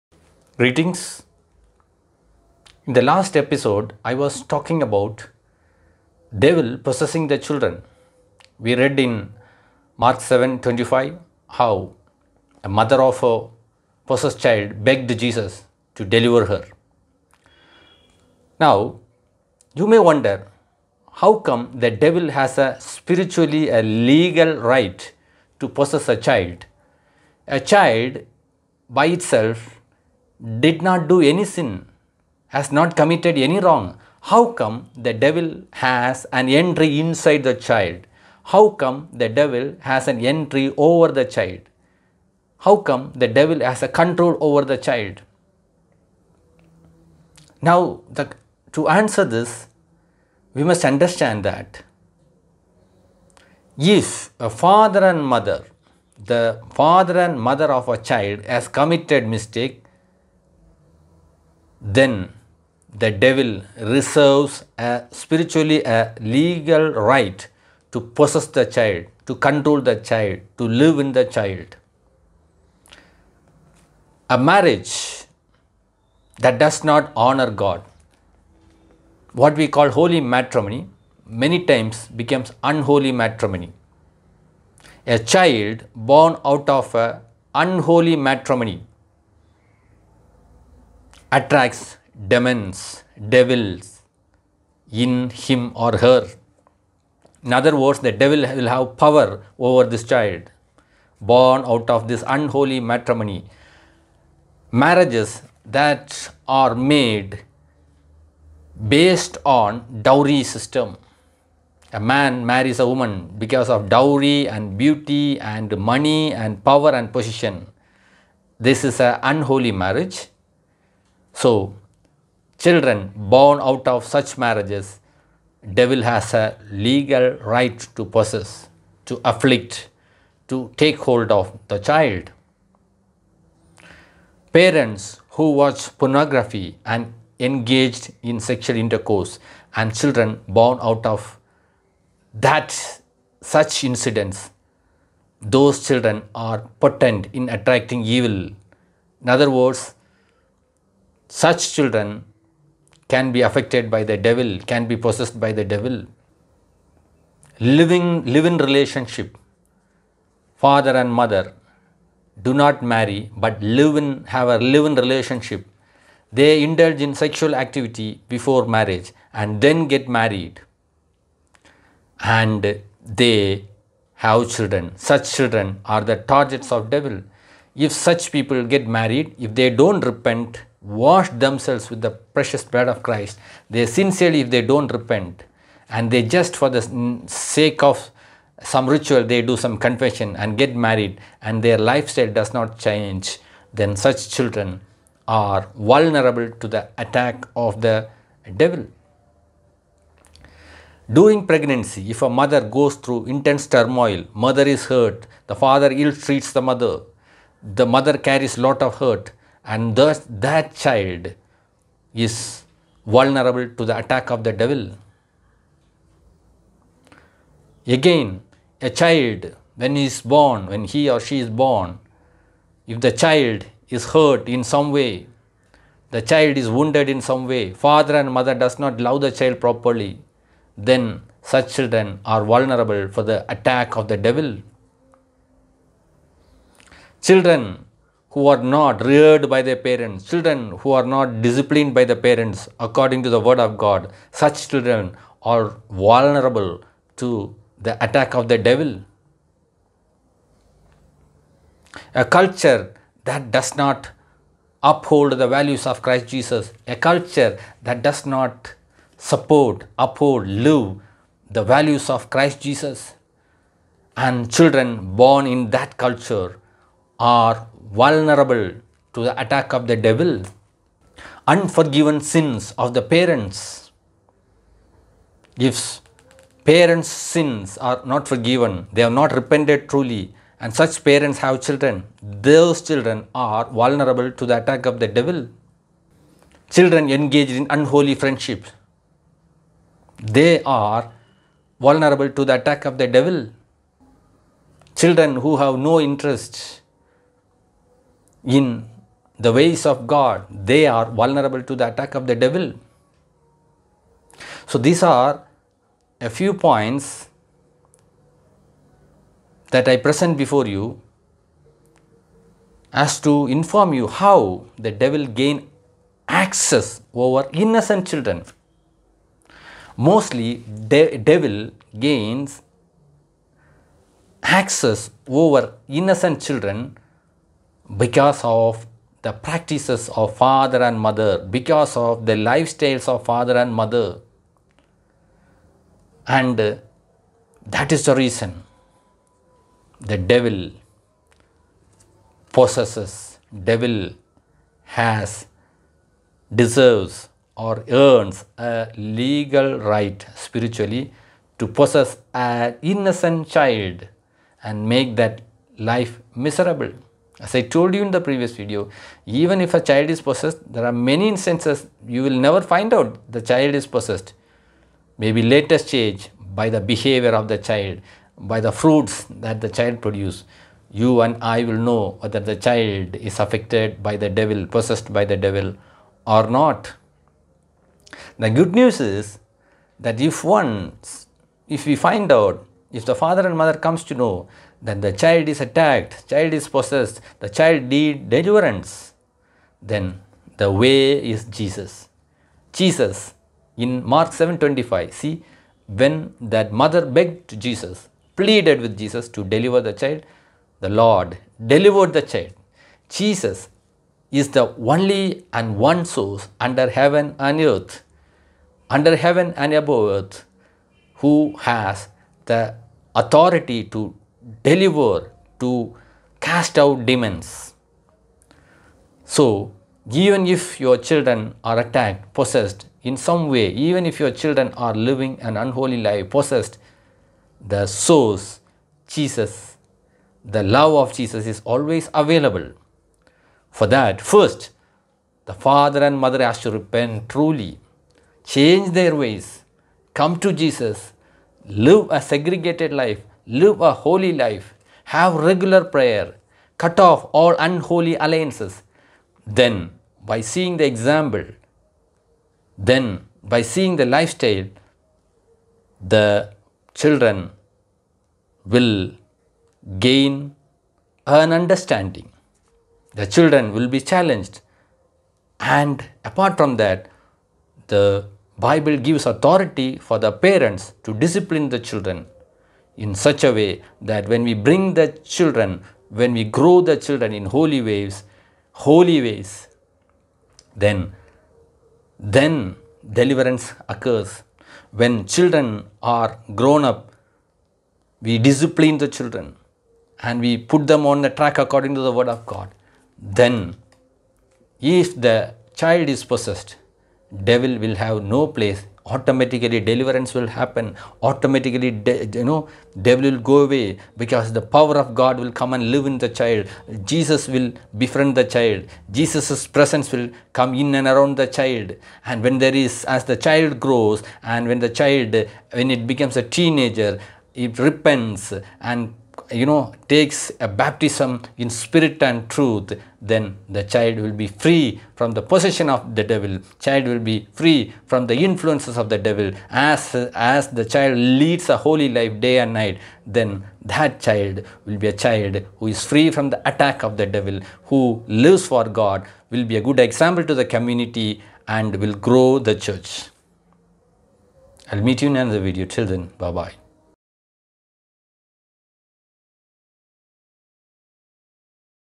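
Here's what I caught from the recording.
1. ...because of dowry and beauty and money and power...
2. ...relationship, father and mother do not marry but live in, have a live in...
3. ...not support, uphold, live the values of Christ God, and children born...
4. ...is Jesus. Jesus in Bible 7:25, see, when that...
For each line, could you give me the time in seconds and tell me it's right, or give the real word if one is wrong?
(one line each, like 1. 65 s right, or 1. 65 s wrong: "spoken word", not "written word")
1. 113 s right
2. 158 s right
3. 258 s wrong: "Jesus", not "God"
4. 391 s wrong: "Mark", not "Bible".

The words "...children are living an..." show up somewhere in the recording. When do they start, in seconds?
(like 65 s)
424 s.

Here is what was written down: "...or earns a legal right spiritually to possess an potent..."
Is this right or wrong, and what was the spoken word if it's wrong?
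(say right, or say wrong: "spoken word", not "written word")
wrong: "innocent", not "potent".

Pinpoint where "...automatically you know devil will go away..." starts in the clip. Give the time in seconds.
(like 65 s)
501 s.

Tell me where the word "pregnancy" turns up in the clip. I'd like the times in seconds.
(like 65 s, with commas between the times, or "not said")
201 s.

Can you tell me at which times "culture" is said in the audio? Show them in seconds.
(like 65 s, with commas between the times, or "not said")
252 s, 256 s, 265 s.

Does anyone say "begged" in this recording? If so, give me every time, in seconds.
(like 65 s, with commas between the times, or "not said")
14 s, 397 s.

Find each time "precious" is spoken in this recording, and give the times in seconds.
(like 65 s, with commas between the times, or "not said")
182 s.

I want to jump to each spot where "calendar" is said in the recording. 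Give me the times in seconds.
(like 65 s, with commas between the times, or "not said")
not said.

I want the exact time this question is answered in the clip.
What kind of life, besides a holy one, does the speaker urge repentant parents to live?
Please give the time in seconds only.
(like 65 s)
442 s.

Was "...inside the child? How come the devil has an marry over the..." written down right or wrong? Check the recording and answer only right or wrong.
wrong.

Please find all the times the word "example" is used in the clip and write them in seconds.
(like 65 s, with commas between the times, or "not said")
450 s, 540 s.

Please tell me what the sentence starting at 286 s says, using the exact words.
Children engaged in unholy friendships, they are vulnerable to the attack of the devil.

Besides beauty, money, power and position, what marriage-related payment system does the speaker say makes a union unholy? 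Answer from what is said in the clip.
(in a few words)
dowry system.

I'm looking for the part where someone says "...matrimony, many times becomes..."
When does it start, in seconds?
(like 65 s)
80 s.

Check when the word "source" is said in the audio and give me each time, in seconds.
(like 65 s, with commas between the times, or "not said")
406 s, 427 s.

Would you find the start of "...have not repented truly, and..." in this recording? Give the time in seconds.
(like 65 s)
279 s.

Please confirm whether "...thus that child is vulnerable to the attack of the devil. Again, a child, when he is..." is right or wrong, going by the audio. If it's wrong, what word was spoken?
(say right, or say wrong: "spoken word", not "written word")
right.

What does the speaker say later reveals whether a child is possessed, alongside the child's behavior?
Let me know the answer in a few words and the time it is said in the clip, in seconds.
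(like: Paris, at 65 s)
the fruits, at 368 s.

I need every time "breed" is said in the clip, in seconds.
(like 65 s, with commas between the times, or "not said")
not said.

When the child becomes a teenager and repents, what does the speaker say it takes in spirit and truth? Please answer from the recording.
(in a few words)
a baptism.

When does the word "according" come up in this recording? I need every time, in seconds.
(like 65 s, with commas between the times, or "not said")
242 s, 491 s.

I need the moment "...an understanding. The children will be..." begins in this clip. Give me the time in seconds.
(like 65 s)
461 s.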